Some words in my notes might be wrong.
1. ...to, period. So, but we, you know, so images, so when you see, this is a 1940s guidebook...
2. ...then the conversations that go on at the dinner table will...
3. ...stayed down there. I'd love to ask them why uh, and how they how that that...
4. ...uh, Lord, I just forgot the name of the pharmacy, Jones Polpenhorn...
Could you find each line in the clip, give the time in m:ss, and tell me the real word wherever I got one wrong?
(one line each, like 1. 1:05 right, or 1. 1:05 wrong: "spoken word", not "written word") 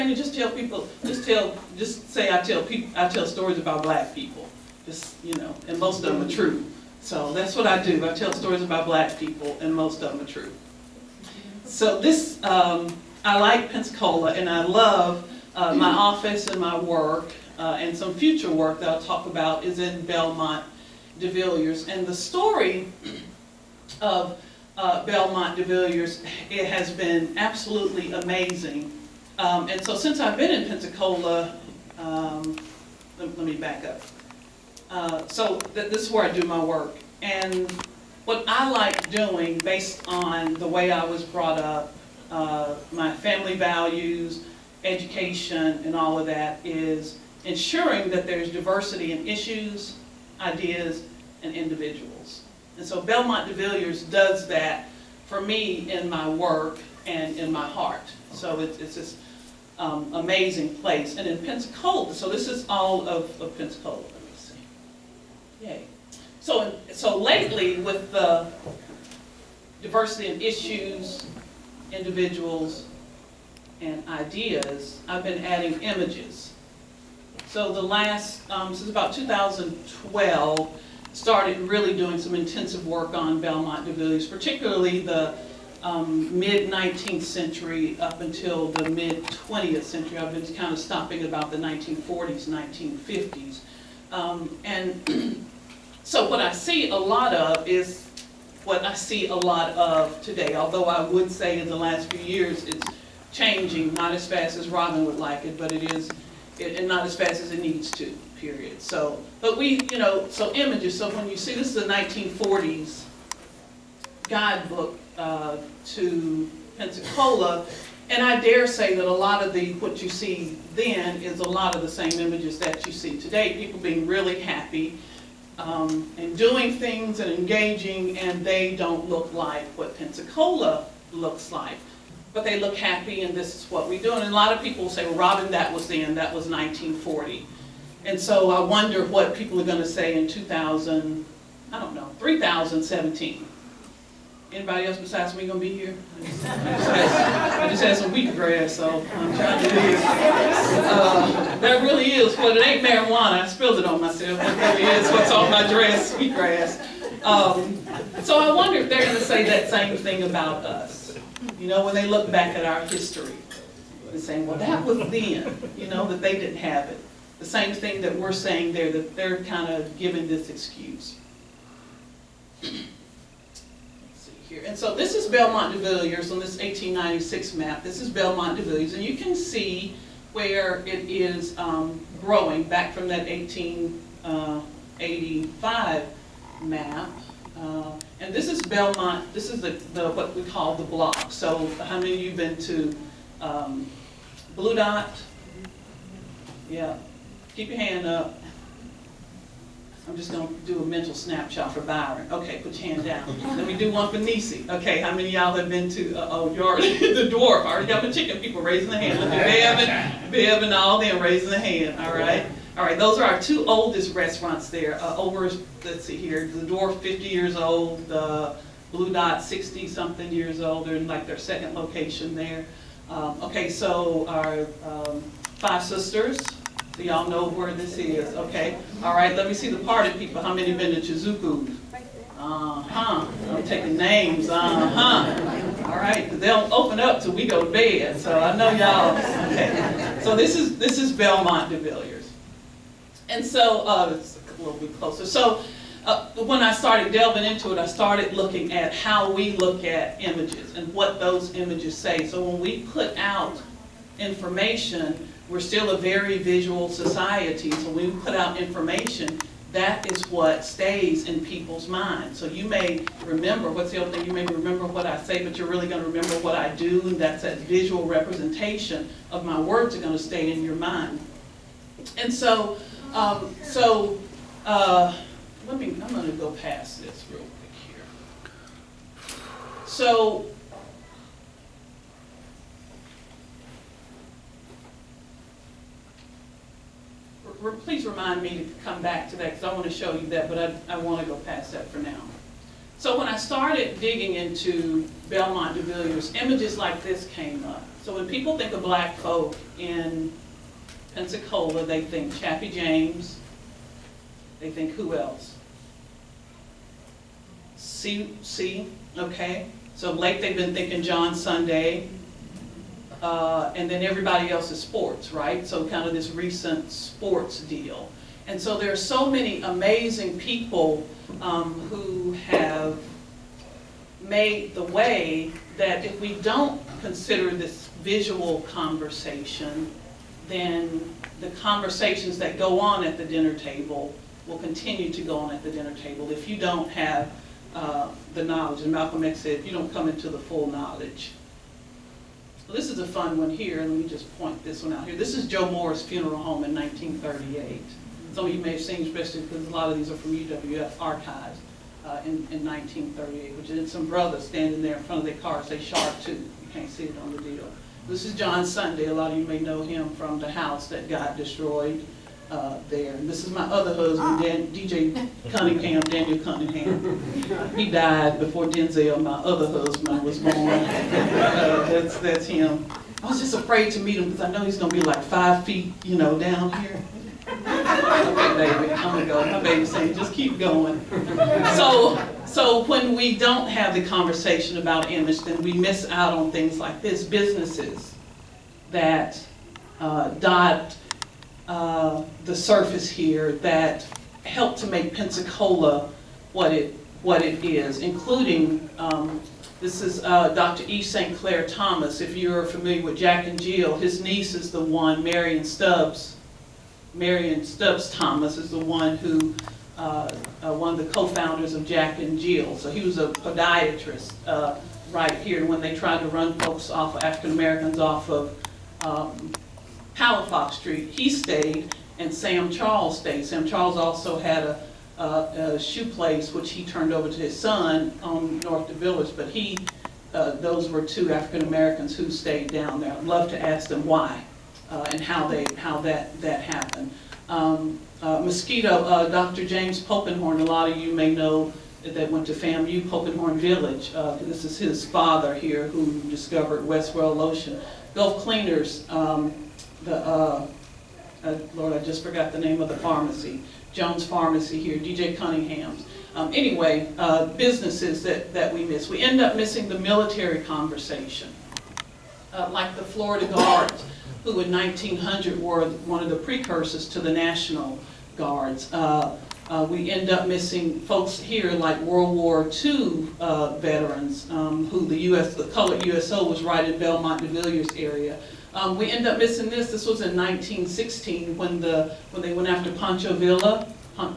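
1. 1:47 right
2. 5:30 right
3. 7:12 right
4. 7:31 wrong: "Pharmacy", not "Polpenhorn".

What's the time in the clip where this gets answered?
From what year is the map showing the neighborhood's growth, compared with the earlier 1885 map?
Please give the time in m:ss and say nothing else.
2:56.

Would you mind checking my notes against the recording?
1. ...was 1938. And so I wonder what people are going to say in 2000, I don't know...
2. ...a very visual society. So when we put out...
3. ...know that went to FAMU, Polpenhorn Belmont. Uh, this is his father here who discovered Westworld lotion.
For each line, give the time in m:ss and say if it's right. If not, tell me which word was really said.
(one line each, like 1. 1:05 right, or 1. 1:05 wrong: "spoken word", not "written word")
1. 2:16 wrong: "1940", not "1938"
2. 4:15 right
3. 7:21 wrong: "Village", not "Belmont".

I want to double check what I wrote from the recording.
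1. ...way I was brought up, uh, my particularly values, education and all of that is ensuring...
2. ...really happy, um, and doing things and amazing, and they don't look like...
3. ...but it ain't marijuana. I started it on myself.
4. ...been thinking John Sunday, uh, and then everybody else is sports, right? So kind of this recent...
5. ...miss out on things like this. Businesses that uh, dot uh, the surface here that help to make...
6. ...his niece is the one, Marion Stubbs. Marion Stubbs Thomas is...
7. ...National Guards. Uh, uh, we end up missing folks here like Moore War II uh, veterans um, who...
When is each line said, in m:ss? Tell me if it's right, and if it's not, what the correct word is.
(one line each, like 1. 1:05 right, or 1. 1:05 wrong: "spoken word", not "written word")
1. 0:40 wrong: "family", not "particularly"
2. 2:04 wrong: "engaging", not "amazing"
3. 2:32 wrong: "spilled", not "started"
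4. 5:10 right
5. 6:25 right
6. 6:43 right
7. 7:47 wrong: "World", not "Moore".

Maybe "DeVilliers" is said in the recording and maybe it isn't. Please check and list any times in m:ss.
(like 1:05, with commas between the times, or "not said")
1:23, 7:08.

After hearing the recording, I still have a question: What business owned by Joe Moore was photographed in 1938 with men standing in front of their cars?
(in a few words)
Funeral home.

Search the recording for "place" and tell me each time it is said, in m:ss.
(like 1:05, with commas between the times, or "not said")
1:00, 7:06.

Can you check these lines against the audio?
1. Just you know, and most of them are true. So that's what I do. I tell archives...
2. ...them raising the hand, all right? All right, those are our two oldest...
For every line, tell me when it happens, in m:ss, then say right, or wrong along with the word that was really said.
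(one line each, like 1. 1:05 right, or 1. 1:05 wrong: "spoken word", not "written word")
1. 0:04 wrong: "stories", not "archives"
2. 3:30 right.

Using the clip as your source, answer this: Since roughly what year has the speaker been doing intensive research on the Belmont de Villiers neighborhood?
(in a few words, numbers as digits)
2012.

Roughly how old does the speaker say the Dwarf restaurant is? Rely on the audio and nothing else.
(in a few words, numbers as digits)
50 years.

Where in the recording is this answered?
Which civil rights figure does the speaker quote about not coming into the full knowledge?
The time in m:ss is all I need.
5:38.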